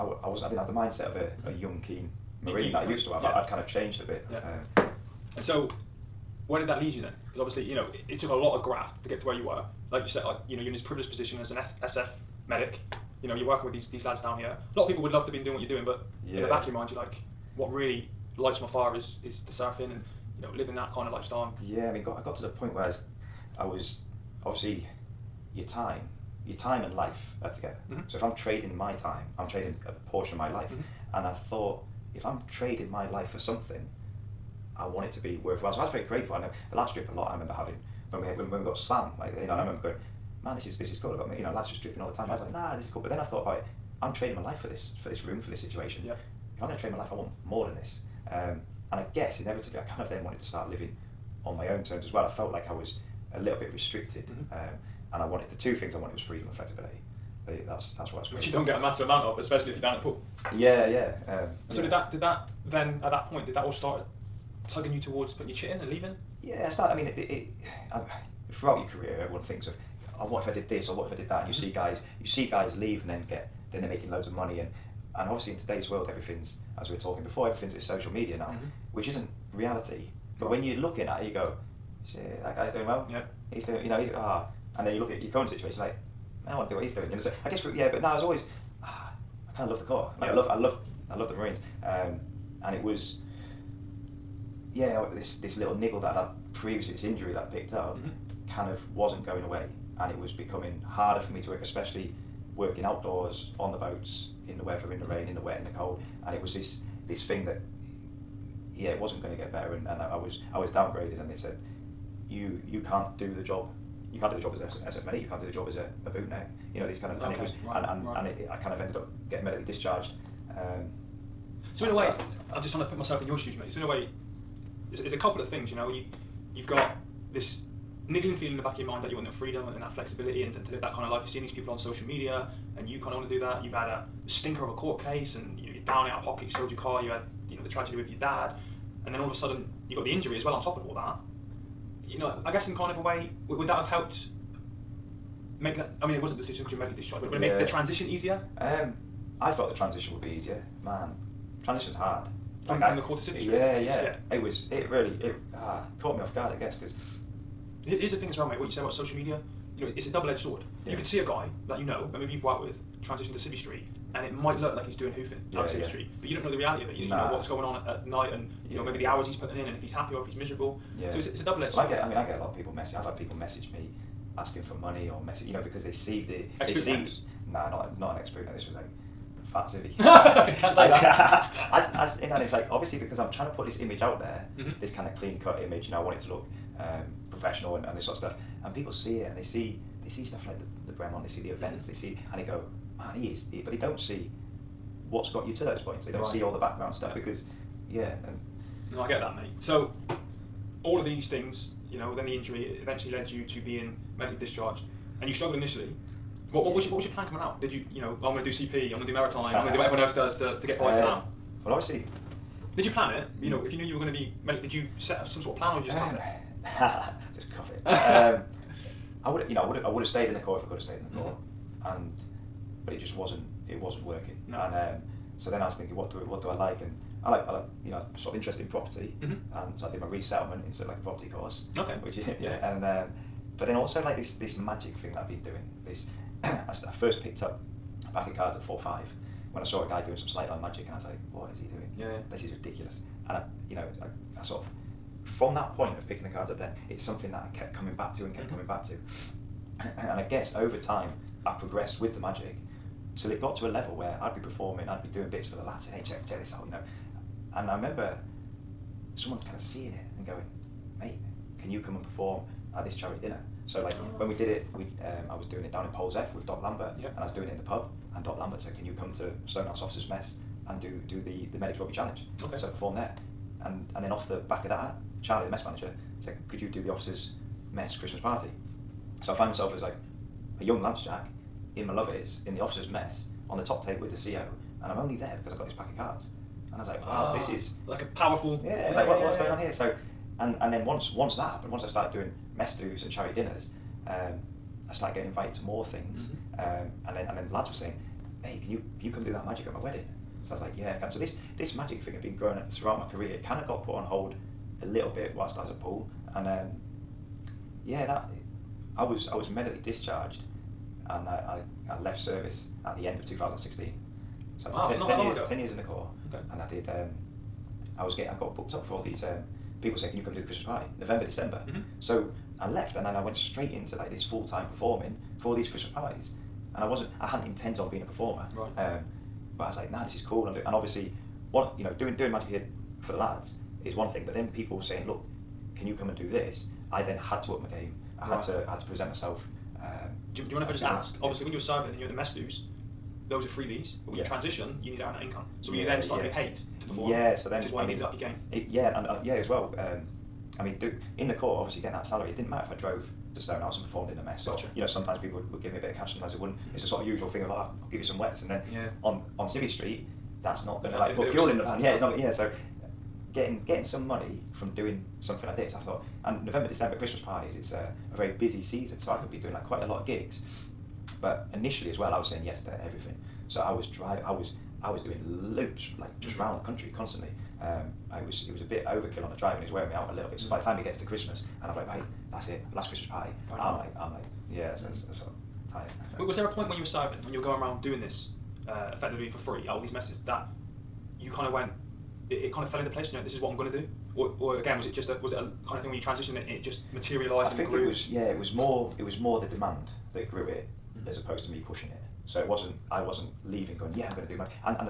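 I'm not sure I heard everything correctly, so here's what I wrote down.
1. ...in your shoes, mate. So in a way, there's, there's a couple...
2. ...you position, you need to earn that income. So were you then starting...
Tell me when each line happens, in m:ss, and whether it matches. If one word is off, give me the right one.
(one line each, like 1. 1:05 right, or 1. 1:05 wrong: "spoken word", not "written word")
1. 2:03 right
2. 5:44 wrong: "transition", not "position".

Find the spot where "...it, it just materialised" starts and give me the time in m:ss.
6:36.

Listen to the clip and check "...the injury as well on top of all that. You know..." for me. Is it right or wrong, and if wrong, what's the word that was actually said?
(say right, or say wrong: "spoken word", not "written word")
right.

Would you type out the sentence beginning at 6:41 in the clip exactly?
as opposed to me pushing it.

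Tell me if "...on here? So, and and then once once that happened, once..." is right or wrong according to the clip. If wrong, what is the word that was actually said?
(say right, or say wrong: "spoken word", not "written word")
right.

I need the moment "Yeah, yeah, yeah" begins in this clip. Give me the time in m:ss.
2:33.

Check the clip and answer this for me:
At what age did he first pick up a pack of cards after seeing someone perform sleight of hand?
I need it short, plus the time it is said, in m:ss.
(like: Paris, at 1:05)
4 or 5, at 3:58.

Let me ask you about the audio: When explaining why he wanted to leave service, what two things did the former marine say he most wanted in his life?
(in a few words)
Freedom and flexibility.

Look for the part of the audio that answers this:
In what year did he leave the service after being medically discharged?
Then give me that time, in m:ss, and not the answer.
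5:13.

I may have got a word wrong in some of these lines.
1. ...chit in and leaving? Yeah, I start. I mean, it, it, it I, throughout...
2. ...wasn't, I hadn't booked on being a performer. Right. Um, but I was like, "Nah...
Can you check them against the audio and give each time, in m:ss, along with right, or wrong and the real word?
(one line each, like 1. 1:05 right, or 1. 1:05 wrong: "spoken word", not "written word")
1. 1:05 right
2. 5:26 wrong: "intended", not "booked".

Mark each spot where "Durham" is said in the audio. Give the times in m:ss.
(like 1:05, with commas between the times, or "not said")
not said.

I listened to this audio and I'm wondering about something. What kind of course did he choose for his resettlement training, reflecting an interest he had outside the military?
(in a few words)
Property course.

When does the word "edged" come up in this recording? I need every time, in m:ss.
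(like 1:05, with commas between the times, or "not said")
2:40, 2:51.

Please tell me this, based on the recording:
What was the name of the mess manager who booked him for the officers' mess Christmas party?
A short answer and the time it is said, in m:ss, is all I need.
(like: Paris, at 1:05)
Charlie, at 4:35.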